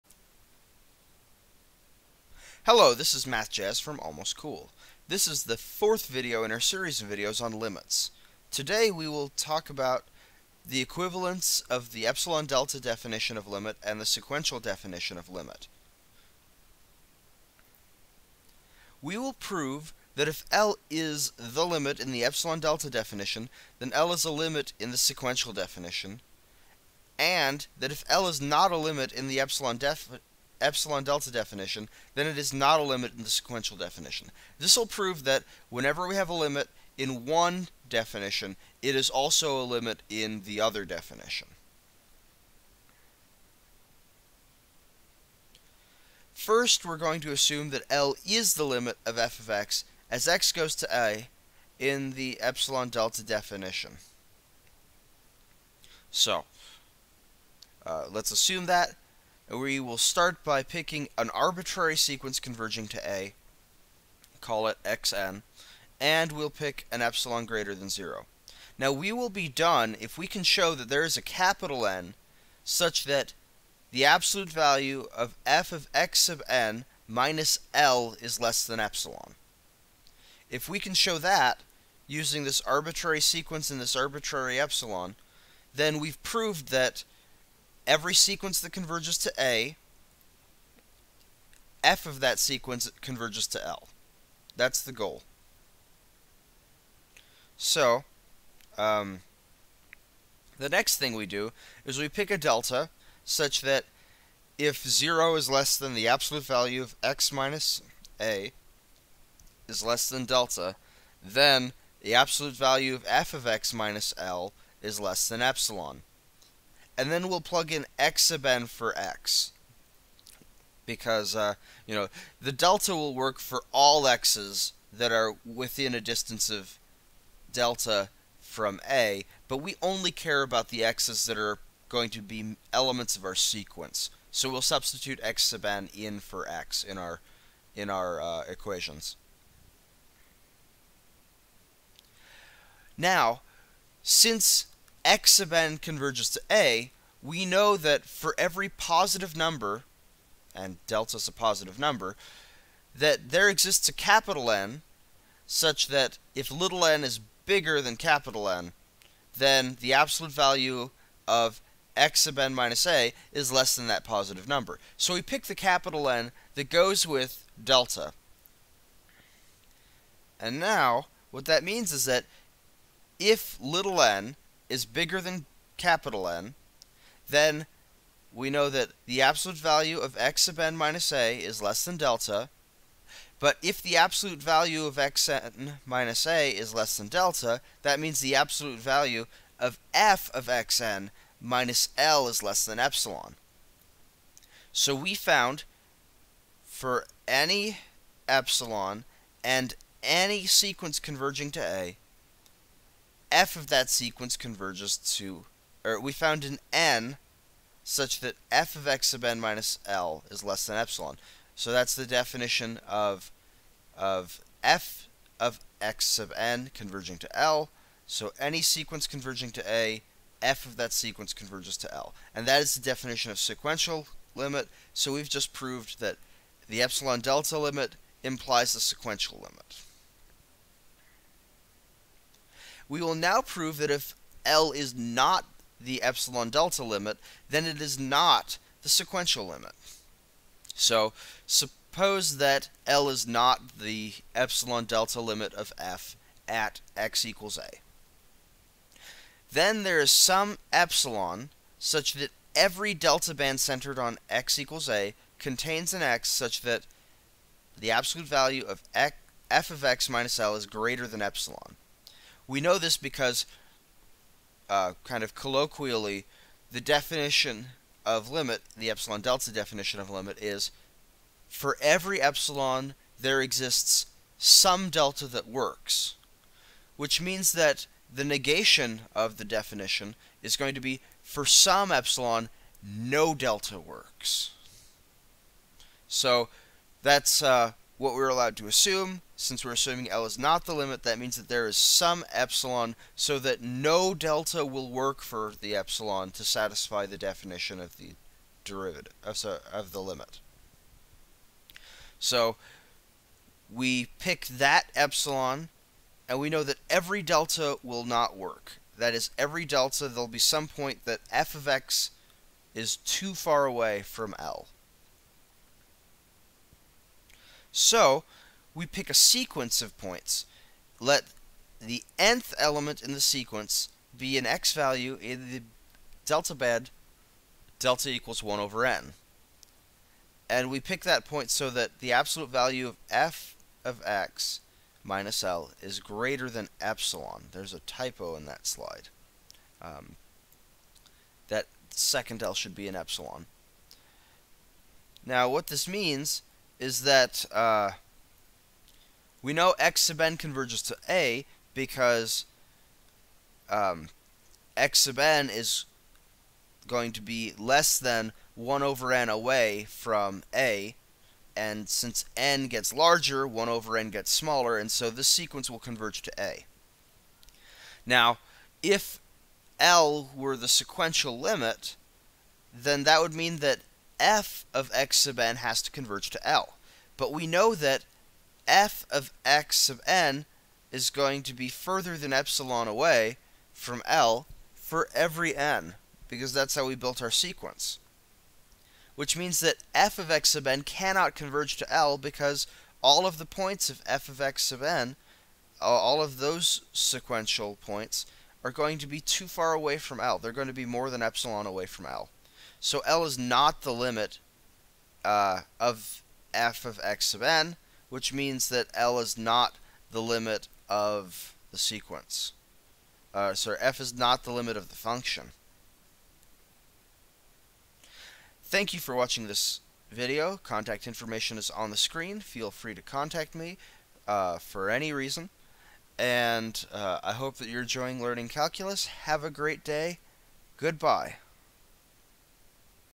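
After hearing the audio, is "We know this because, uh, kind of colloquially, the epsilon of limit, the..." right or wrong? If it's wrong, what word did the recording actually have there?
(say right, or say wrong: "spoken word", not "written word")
wrong: "definition", not "epsilon".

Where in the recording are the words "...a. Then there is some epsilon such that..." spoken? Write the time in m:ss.
4:07.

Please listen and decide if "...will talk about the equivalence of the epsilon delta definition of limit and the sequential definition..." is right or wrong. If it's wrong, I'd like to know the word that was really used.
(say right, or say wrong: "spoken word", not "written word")
right.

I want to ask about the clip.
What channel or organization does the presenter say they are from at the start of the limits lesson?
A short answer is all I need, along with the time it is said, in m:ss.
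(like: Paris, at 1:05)
Almost Cool, at 0:04.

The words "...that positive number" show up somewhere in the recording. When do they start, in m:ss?
2:43.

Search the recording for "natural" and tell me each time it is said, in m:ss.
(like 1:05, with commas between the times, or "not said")
not said.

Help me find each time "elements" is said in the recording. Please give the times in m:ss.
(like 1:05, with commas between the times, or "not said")
2:12, 5:22.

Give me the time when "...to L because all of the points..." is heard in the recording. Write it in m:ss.
6:31.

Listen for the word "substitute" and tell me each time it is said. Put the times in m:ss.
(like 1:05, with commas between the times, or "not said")
2:14.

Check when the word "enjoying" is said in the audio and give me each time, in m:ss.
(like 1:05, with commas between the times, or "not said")
7:07.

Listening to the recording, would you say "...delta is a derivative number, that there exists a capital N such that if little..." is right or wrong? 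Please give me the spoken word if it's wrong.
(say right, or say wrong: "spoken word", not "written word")
wrong: "positive", not "derivative".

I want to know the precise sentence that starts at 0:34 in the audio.
This will prove that whenever we have a limit in one definition, it is also a limit in the other definition.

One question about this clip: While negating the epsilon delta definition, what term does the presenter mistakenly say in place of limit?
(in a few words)
derivative.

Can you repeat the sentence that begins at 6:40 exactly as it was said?
They're going to be more than epsilon away from L.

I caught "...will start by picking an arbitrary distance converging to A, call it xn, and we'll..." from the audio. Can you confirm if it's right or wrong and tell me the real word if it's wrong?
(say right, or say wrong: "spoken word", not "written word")
wrong: "sequence", not "distance".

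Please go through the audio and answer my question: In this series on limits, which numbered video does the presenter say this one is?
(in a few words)
fourth.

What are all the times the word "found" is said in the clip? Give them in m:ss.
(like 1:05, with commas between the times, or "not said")
3:15, 3:26.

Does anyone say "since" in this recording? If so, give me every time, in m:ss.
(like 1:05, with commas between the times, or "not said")
2:24, 4:49, 6:01.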